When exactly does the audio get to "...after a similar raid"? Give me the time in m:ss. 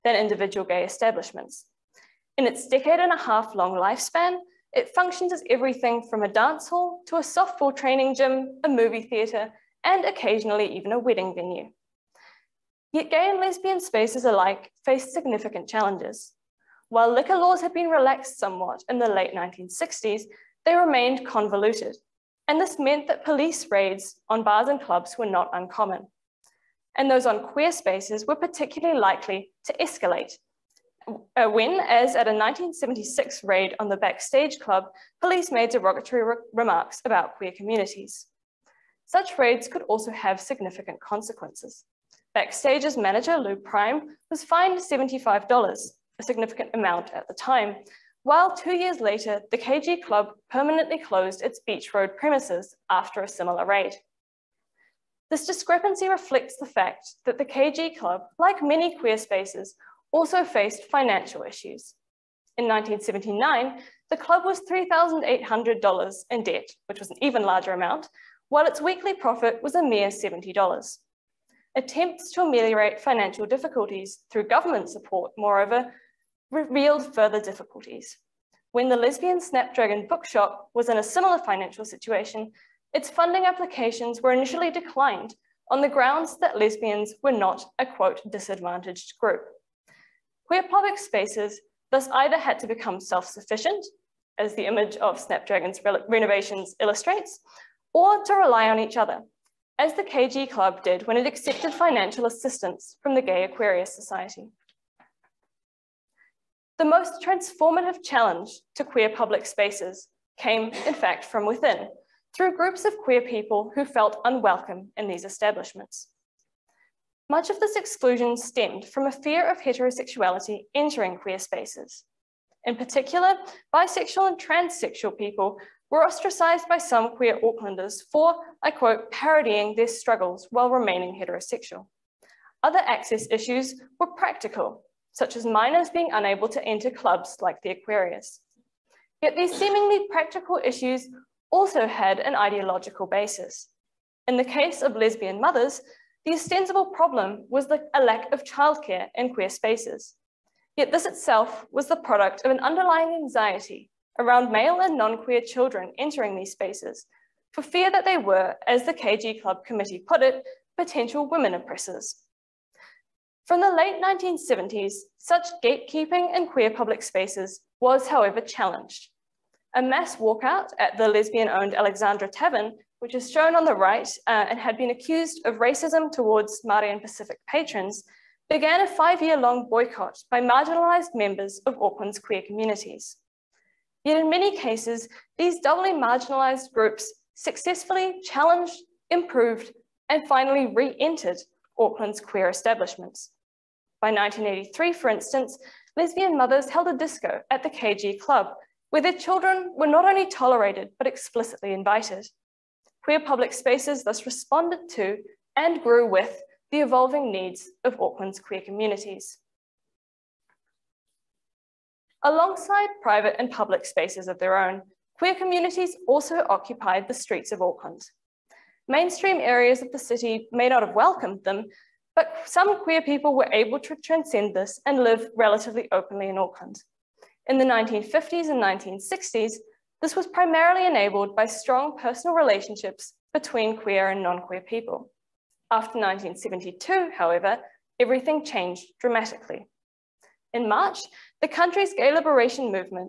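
0:52.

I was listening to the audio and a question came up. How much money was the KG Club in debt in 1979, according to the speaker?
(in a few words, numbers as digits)
$3,800.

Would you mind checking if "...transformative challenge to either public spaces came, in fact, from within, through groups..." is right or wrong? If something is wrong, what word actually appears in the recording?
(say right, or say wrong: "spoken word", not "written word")
wrong: "queer", not "either".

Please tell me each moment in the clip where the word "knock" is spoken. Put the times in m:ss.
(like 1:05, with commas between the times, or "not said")
not said.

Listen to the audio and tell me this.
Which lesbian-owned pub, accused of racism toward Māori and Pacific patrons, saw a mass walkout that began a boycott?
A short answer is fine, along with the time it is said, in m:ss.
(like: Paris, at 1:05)
Alexandra Tavern, at 2:51.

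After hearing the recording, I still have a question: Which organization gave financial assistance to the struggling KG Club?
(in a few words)
Gay Aquarius Society.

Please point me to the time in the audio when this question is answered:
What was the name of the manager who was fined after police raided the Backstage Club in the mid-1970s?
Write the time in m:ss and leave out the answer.
0:43.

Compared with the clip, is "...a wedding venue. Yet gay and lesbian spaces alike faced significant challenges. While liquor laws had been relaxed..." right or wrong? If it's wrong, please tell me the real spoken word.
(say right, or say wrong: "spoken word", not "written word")
right.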